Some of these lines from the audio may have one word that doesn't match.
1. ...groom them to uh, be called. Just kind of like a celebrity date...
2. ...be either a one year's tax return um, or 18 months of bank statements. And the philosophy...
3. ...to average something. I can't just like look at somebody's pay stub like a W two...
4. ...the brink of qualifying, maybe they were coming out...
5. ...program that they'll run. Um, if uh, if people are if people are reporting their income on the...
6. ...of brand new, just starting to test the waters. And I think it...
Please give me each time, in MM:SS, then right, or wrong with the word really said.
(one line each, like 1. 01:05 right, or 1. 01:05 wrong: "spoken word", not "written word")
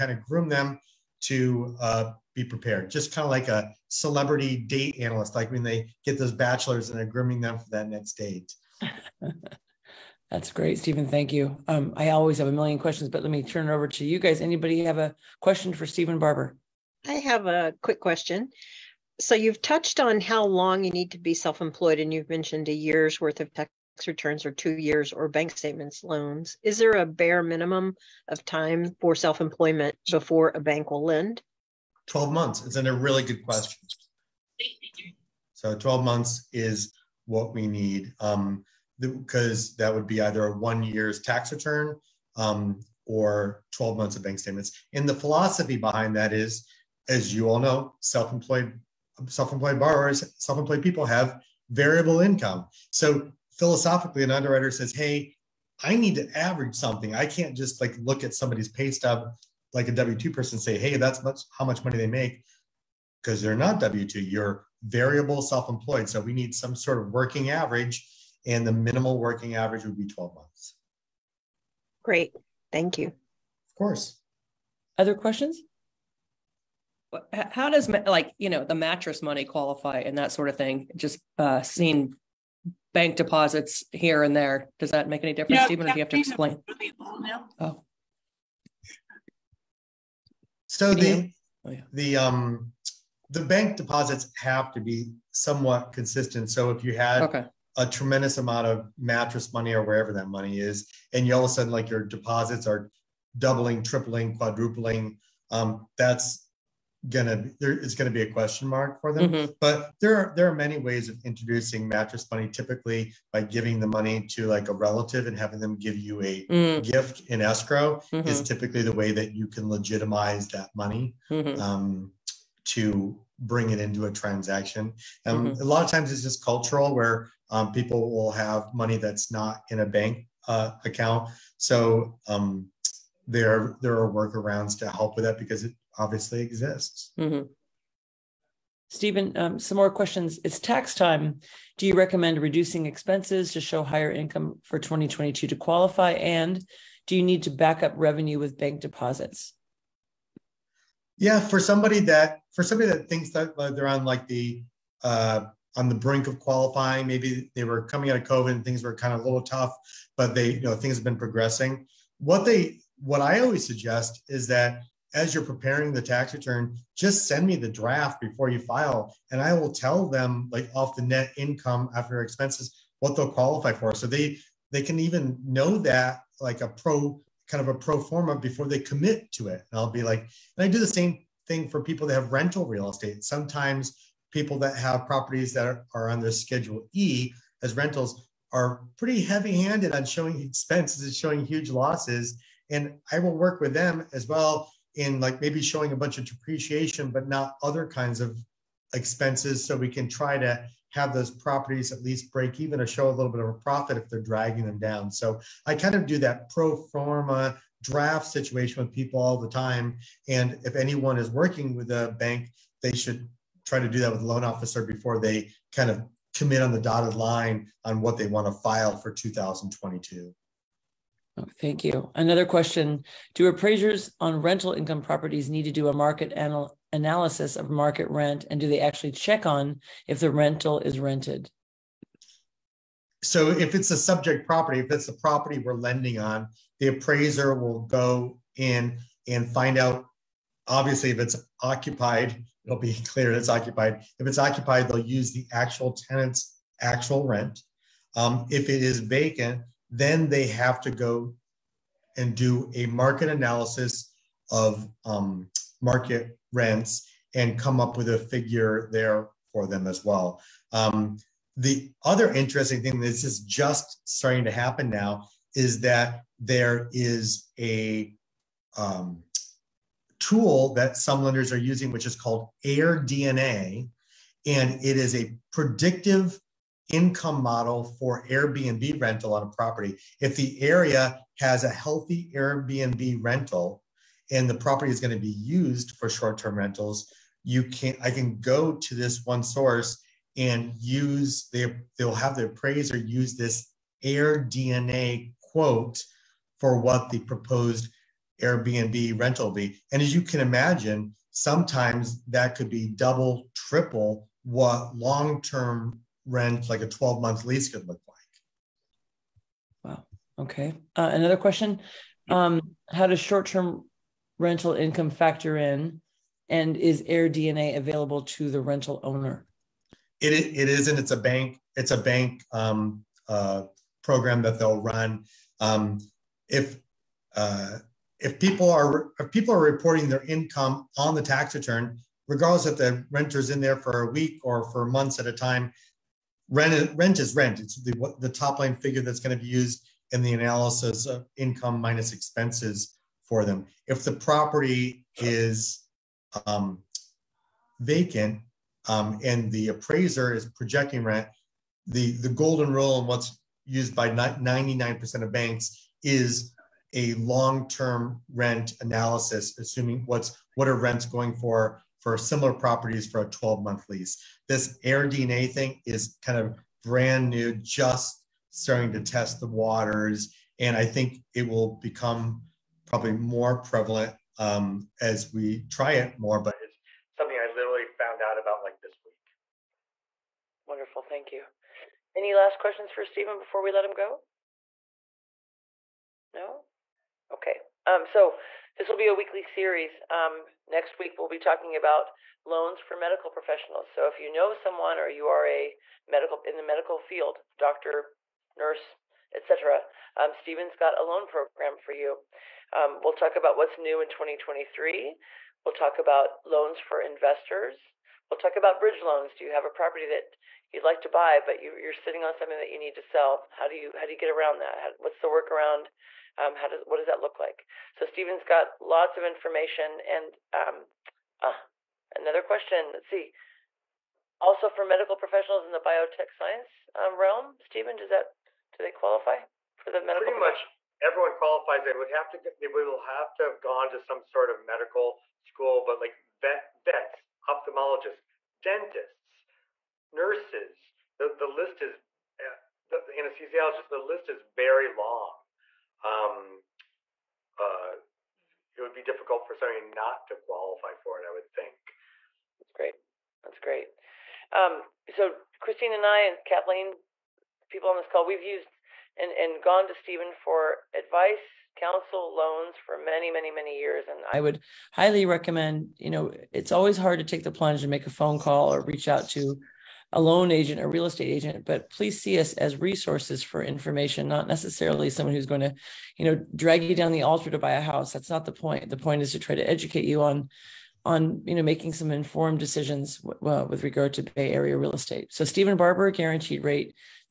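1. 00:00 wrong: "prepared", not "called"
2. 00:40 wrong: "12", not "18"
3. 00:56 right
4. 02:35 right
5. 05:24 right
6. 06:06 right.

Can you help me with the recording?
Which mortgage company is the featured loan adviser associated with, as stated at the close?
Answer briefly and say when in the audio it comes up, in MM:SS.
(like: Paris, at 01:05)
Guaranteed Rate, at 08:06.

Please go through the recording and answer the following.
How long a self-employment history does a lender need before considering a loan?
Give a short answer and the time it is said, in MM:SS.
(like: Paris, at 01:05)
12 months, at 00:35.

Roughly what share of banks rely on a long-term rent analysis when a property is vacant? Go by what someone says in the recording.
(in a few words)
99%.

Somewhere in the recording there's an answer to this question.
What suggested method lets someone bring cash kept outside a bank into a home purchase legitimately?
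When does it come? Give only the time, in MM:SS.
01:56.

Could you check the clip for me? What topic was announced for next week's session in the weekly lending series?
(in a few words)
loans for medical professionals.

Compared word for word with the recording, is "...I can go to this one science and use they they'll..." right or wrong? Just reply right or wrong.
wrong.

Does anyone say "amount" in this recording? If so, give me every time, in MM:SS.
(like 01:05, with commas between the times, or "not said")
01:38.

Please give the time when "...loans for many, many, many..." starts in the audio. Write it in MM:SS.
07:42.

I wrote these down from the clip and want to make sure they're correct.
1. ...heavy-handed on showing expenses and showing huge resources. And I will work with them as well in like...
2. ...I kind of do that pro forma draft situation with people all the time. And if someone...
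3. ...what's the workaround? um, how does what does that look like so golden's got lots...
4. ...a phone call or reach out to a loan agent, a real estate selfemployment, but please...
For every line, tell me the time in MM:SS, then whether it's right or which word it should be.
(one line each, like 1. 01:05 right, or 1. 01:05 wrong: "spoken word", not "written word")
1. 03:09 wrong: "losses", not "resources"
2. 03:25 wrong: "anyone", not "someone"
3. 06:54 wrong: "steven", not "golden"
4. 07:48 wrong: "agent", not "selfemployment".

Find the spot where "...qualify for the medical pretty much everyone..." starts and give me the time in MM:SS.
07:08.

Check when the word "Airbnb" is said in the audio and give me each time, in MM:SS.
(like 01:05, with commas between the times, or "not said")
04:38, 04:42, 04:58.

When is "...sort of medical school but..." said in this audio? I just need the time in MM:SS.
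07:14.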